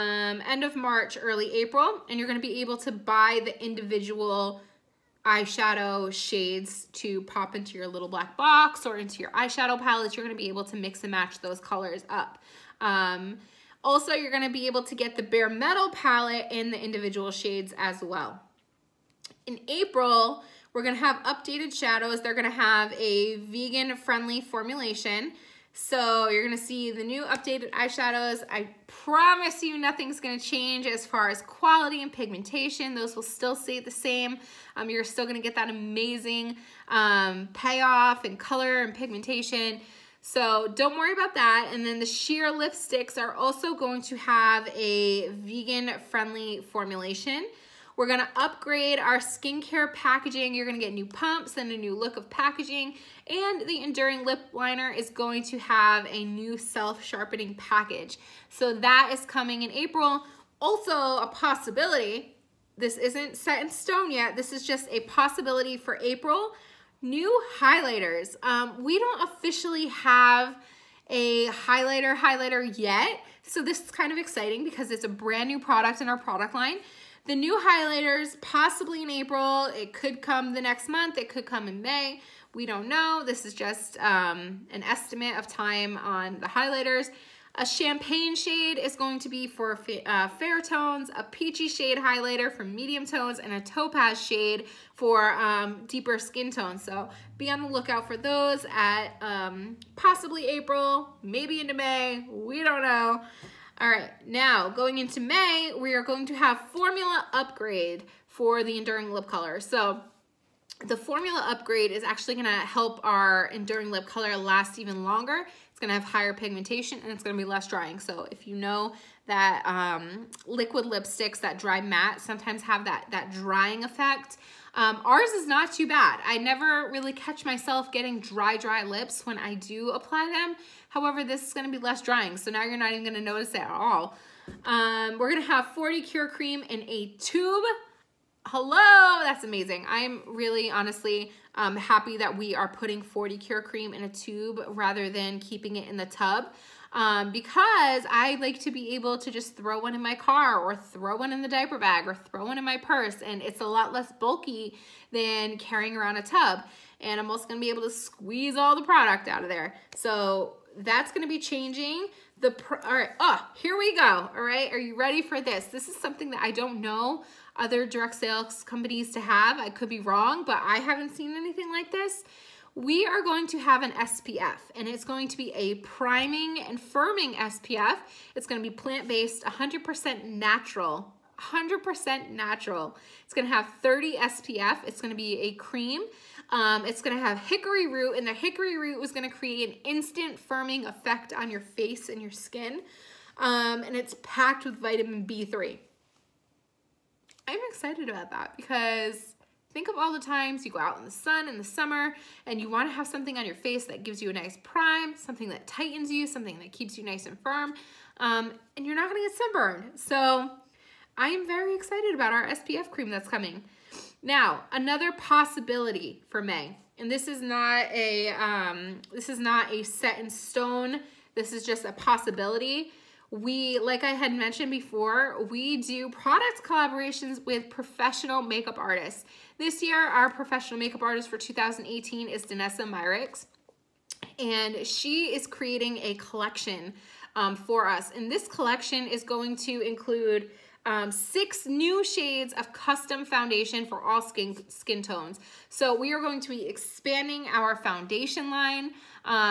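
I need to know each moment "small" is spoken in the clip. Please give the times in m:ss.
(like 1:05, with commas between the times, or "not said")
not said.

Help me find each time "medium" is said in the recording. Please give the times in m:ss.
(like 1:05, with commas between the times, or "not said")
1:32.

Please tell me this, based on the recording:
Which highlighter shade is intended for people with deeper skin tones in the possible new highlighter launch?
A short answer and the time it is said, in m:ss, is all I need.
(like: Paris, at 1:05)
Topaz, at 1:33.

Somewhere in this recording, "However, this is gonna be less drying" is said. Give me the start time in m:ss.
2:10.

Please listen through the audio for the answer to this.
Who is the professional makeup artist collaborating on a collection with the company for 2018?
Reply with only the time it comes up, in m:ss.
3:52.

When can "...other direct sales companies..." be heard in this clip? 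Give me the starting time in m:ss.
2:47.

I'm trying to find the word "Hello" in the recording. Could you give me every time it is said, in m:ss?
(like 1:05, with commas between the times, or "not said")
2:18.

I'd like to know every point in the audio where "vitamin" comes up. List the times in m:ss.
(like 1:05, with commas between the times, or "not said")
3:14.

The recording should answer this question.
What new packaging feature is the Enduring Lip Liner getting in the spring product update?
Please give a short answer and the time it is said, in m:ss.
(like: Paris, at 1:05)
Self-sharpening package, at 0:56.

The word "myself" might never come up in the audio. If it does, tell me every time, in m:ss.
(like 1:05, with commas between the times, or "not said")
2:07.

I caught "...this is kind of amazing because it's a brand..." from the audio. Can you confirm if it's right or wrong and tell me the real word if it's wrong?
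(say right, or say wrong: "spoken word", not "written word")
wrong: "exciting", not "amazing".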